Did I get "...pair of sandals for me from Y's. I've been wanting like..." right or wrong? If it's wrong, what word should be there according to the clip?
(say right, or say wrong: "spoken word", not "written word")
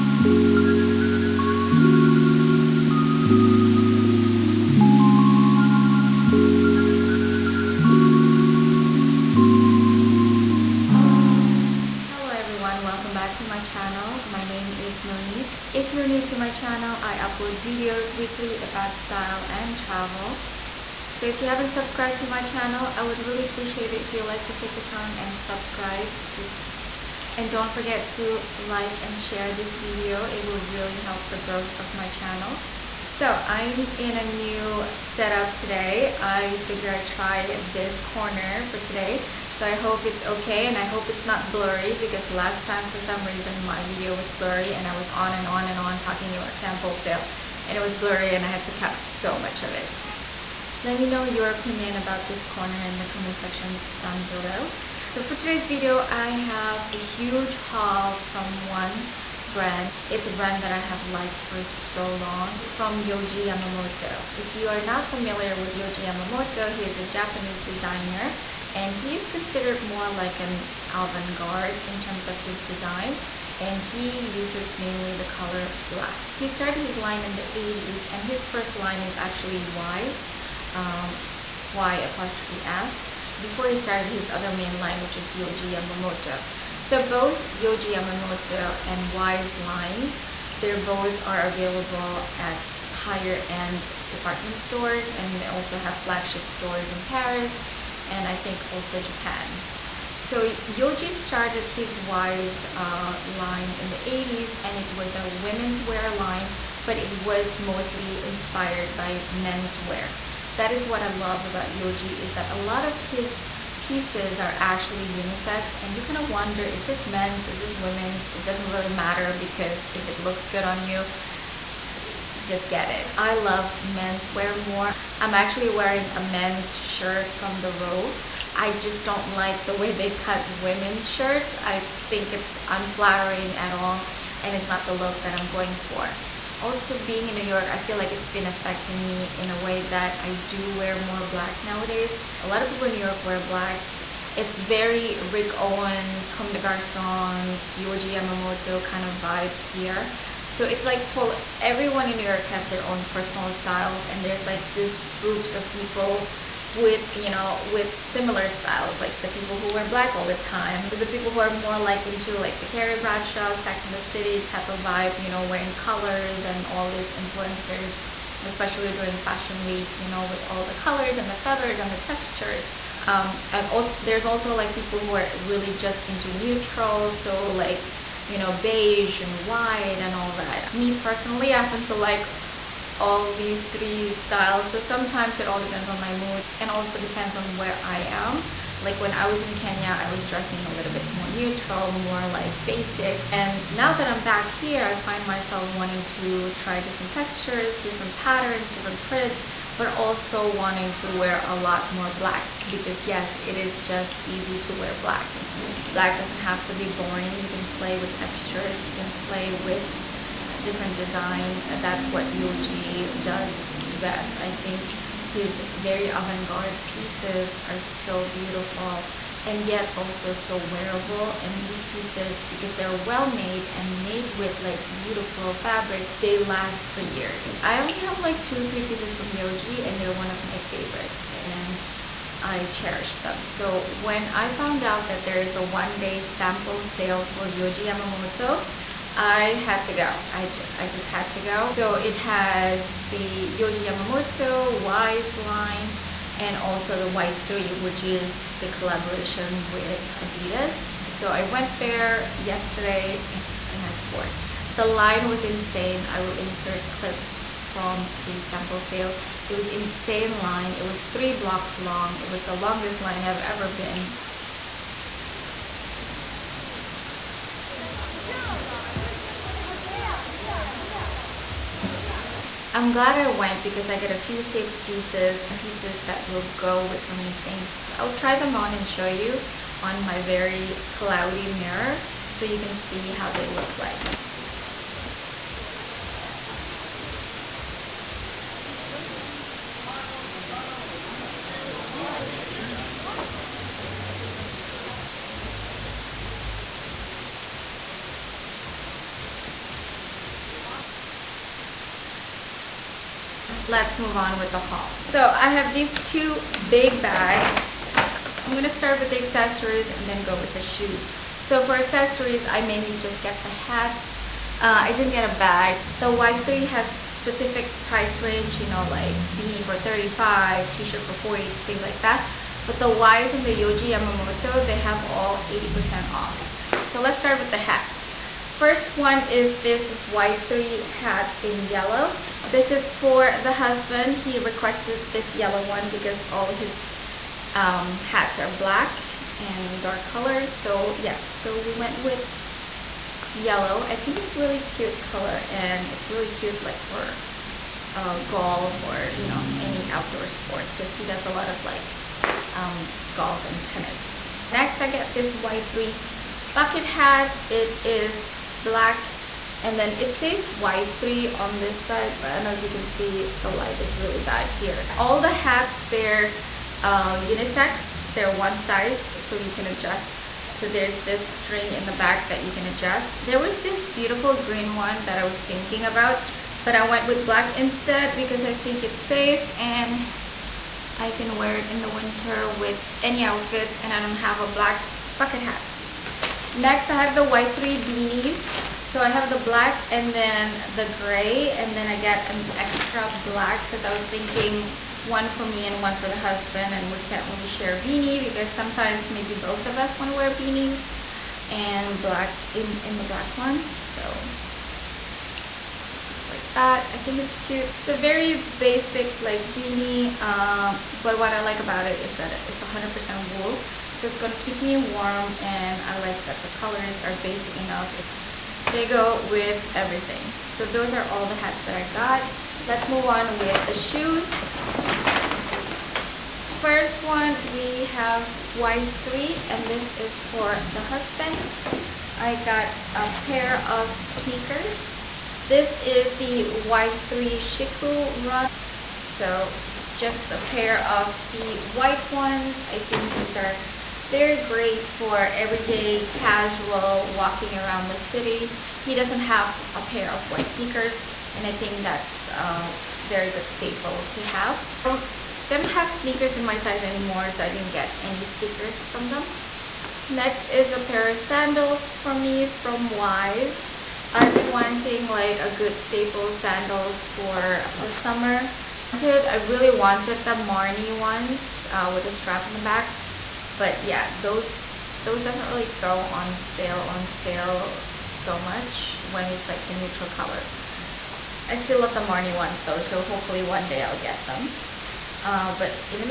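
right.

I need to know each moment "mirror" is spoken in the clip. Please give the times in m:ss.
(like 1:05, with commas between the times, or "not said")
4:41.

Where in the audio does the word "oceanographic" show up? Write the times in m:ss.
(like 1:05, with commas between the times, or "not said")
not said.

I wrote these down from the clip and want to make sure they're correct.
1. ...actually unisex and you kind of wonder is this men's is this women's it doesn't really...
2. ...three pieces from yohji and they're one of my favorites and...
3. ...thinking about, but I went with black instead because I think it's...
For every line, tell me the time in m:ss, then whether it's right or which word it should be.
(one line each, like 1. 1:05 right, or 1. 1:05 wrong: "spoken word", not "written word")
1. 1:54 right
2. 3:48 right
3. 6:15 right.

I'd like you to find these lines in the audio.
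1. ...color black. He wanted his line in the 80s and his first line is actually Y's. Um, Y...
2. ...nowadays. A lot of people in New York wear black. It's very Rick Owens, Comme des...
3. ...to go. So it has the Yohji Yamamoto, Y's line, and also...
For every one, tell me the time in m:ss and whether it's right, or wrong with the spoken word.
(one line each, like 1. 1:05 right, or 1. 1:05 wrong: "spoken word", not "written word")
1. 1:15 wrong: "started", not "wanted"
2. 2:21 right
3. 4:01 right.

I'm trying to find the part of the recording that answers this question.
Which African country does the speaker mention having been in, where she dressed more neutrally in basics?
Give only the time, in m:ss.
3:09.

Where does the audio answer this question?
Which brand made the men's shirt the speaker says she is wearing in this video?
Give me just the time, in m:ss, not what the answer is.
2:07.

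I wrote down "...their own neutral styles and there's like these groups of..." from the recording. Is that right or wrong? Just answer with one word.
wrong.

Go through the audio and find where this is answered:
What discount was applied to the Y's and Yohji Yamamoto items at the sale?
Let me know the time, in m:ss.
5:25.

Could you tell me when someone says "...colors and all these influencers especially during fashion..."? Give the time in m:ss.
2:45.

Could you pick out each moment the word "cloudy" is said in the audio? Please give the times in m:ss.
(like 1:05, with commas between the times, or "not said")
4:40.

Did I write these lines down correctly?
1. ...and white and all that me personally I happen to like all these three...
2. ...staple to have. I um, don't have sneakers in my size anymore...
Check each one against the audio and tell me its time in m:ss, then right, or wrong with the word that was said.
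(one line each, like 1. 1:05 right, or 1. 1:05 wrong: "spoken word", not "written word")
1. 2:59 right
2. 7:33 right.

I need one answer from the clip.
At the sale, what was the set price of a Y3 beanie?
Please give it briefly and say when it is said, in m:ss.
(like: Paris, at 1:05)
35, at 5:19.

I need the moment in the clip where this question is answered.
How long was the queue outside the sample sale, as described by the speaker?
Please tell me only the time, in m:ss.
4:20.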